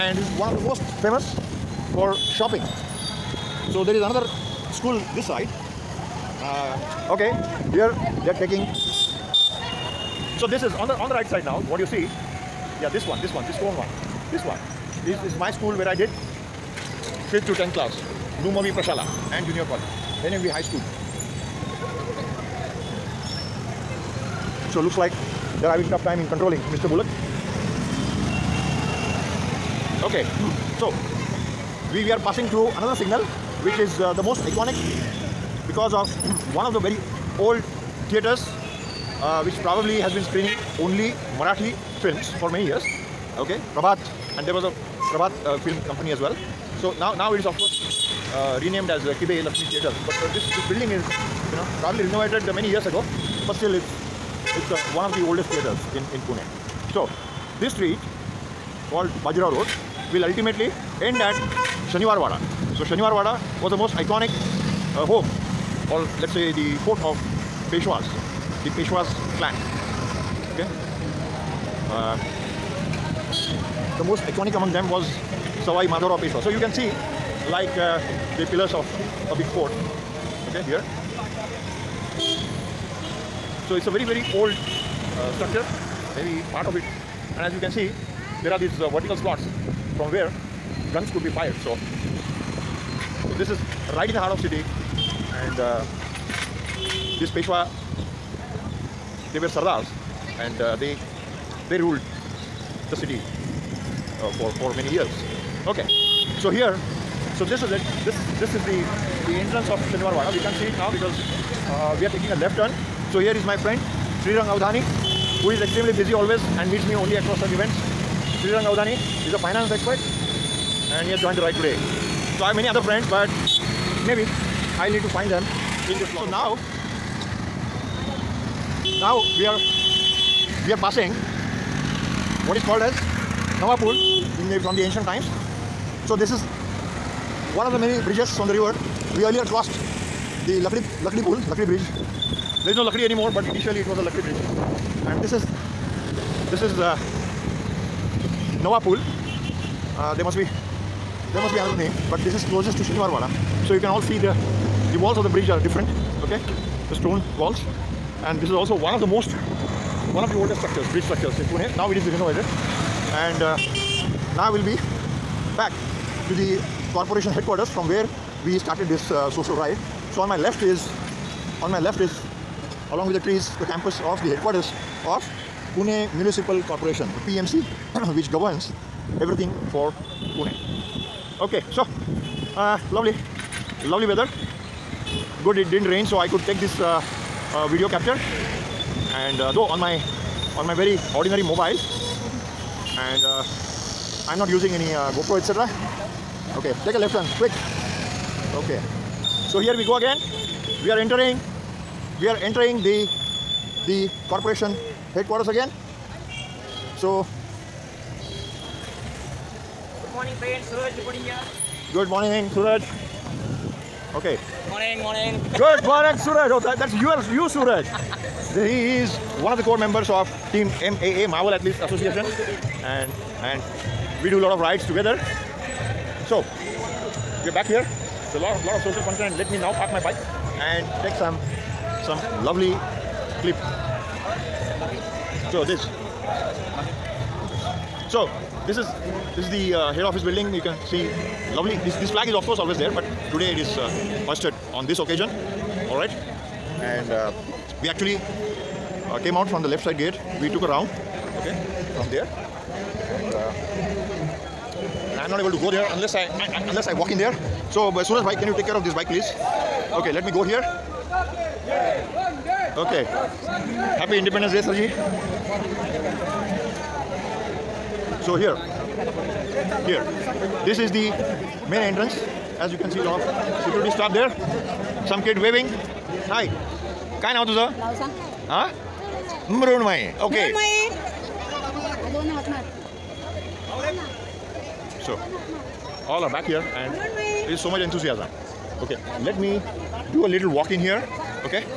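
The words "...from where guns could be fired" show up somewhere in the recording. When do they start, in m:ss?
1:29.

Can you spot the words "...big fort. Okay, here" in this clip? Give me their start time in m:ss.
1:19.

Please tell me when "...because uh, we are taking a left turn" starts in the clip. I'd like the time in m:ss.
1:50.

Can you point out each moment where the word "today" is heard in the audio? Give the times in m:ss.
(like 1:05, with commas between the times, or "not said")
2:01, 4:03.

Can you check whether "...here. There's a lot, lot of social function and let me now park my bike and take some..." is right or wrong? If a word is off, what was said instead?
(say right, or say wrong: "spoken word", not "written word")
right.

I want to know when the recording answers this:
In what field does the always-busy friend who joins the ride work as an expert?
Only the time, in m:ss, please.
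1:59.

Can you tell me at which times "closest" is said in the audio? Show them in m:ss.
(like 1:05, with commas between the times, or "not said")
2:32.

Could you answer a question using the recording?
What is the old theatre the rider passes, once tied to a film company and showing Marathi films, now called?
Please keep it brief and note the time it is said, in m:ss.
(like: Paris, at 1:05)
Kibe Lakshmi Theatre, at 0:49.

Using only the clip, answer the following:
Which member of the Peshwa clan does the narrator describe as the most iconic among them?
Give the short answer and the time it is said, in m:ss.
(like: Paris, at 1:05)
Sawai Madhavrao Peshwa, at 1:15.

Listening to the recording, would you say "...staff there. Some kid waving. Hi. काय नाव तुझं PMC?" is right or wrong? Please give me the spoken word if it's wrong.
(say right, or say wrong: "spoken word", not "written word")
wrong: "Huh", not "PMC".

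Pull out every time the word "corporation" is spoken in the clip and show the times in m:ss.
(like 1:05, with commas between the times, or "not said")
2:46, 2:56, 3:24.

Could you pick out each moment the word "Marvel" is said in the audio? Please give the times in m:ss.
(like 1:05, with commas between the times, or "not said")
3:41.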